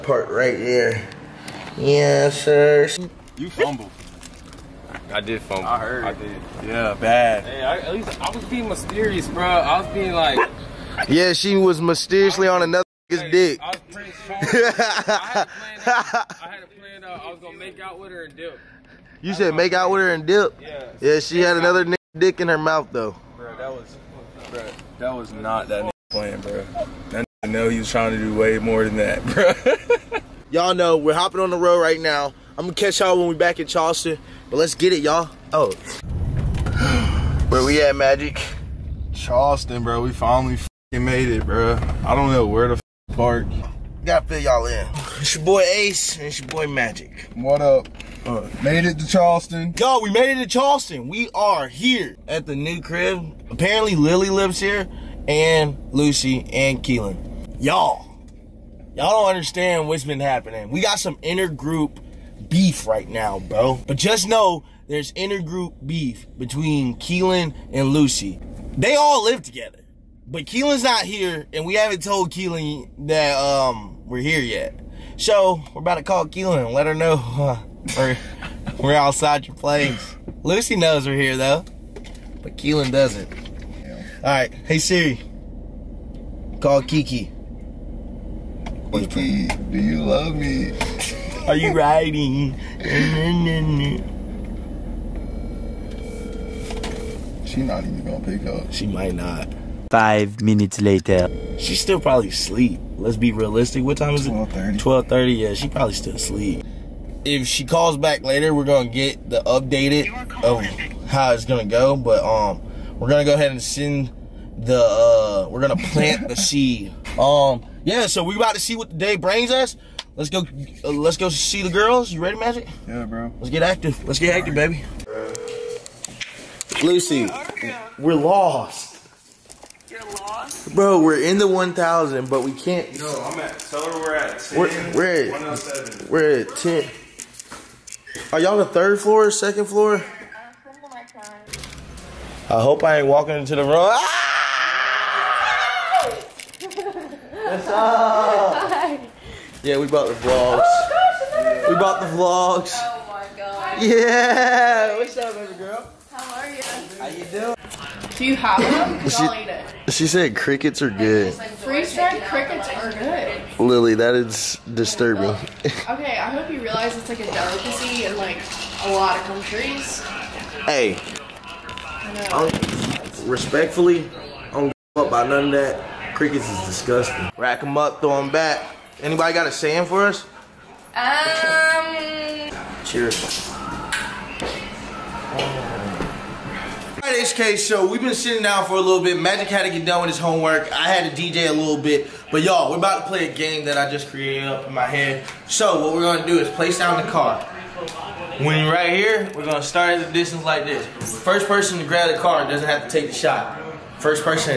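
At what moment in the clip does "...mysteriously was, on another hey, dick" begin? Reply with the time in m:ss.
0:11.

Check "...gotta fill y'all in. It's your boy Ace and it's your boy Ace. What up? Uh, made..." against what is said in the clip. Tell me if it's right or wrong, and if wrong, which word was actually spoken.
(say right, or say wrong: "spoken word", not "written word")
wrong: "Magic", not "Ace".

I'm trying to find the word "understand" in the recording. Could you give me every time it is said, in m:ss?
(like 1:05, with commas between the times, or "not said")
0:59.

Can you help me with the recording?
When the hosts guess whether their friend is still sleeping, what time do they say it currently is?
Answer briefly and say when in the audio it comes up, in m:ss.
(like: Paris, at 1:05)
12:30, at 1:44.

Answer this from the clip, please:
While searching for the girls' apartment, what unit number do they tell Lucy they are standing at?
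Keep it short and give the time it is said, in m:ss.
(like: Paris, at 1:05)
107, at 2:15.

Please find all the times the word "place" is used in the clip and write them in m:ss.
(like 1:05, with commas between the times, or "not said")
1:19, 3:16.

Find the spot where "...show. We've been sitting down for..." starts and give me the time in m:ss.
3:07.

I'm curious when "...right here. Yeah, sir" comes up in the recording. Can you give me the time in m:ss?
0:00.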